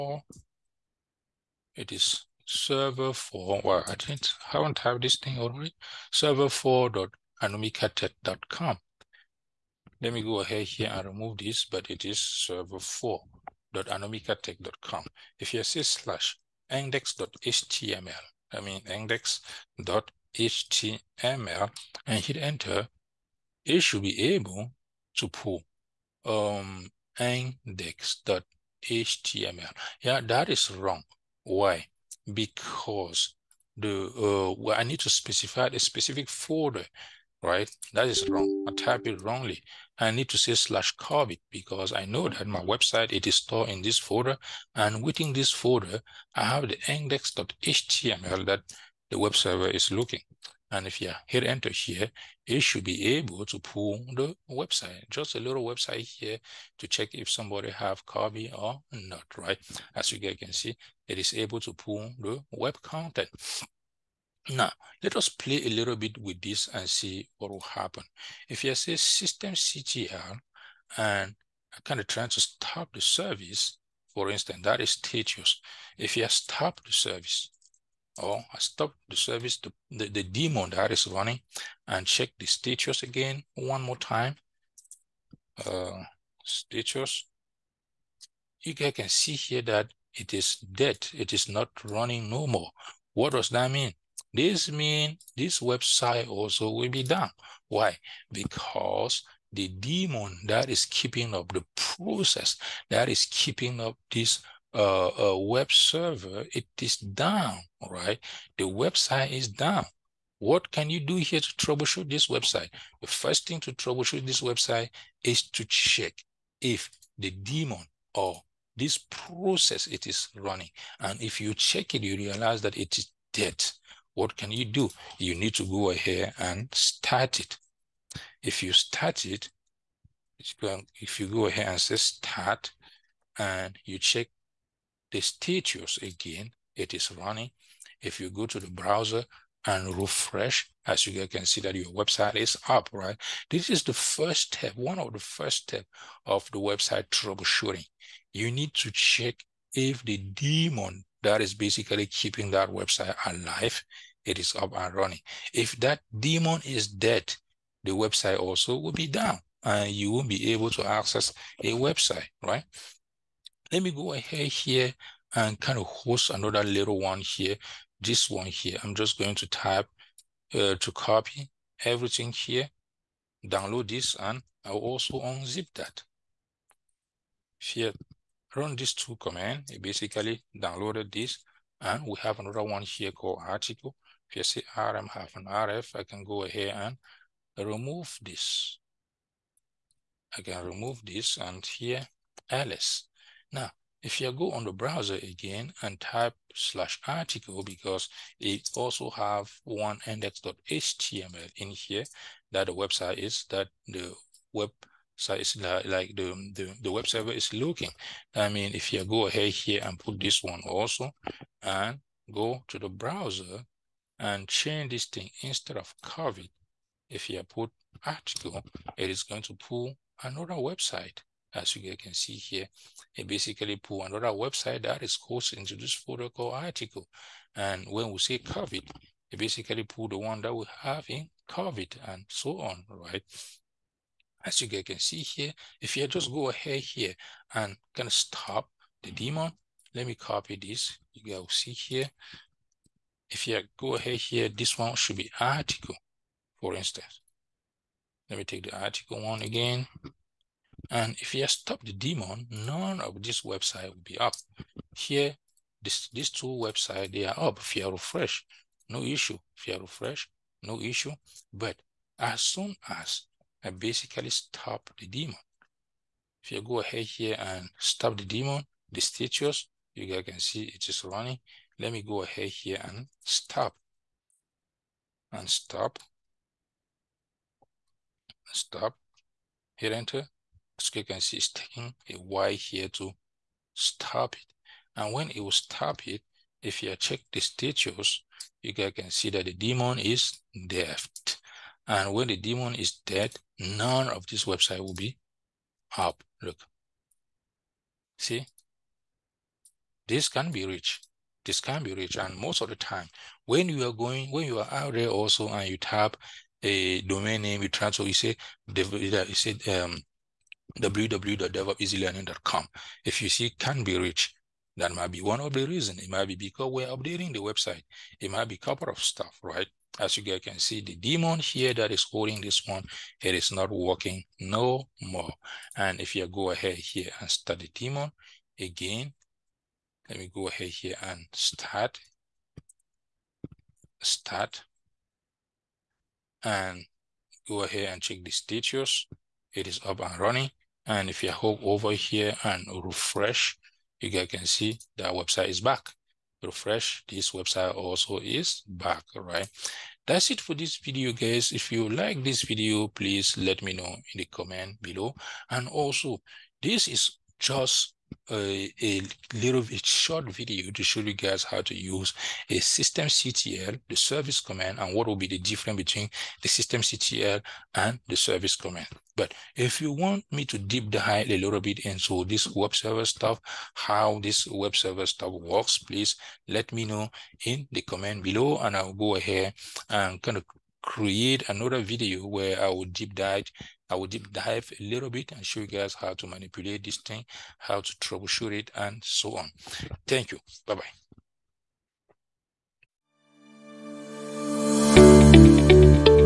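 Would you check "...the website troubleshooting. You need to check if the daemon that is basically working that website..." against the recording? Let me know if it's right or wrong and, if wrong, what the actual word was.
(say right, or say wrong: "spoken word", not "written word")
wrong: "keeping", not "working".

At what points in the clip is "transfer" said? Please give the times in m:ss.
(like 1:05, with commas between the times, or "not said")
5:07.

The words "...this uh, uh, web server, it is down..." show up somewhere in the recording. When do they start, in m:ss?
1:44.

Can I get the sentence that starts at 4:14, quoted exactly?
Here, this, these two websites, they are up.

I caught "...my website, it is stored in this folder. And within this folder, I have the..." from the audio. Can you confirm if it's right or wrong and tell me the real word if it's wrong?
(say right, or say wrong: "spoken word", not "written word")
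right.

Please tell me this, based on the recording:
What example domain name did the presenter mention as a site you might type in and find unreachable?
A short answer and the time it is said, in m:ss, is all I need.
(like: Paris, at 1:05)
www.devopseasylearning.com, at 5:10.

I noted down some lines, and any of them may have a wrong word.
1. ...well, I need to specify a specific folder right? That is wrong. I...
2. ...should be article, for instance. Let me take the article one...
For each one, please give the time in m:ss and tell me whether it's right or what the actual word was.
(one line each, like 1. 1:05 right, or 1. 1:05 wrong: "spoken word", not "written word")
1. 0:34 right
2. 4:04 right.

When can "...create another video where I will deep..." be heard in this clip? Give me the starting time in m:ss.
6:20.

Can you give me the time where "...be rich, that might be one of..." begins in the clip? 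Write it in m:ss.
5:13.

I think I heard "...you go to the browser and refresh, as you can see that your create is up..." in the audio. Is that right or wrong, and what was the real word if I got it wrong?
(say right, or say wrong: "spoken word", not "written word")
wrong: "website", not "create".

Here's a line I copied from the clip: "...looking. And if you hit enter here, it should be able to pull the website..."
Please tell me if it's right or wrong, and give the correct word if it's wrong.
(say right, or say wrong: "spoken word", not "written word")
right.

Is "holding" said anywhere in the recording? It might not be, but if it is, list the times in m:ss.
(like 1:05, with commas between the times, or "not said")
5:22.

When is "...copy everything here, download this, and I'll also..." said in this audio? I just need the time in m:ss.
2:50.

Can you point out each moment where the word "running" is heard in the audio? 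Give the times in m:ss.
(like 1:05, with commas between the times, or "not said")
1:21, 1:31, 2:00, 2:17, 2:34, 4:31, 5:40.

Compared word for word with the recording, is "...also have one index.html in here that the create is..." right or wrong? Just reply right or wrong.
wrong.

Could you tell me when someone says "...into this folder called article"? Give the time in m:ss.
3:45.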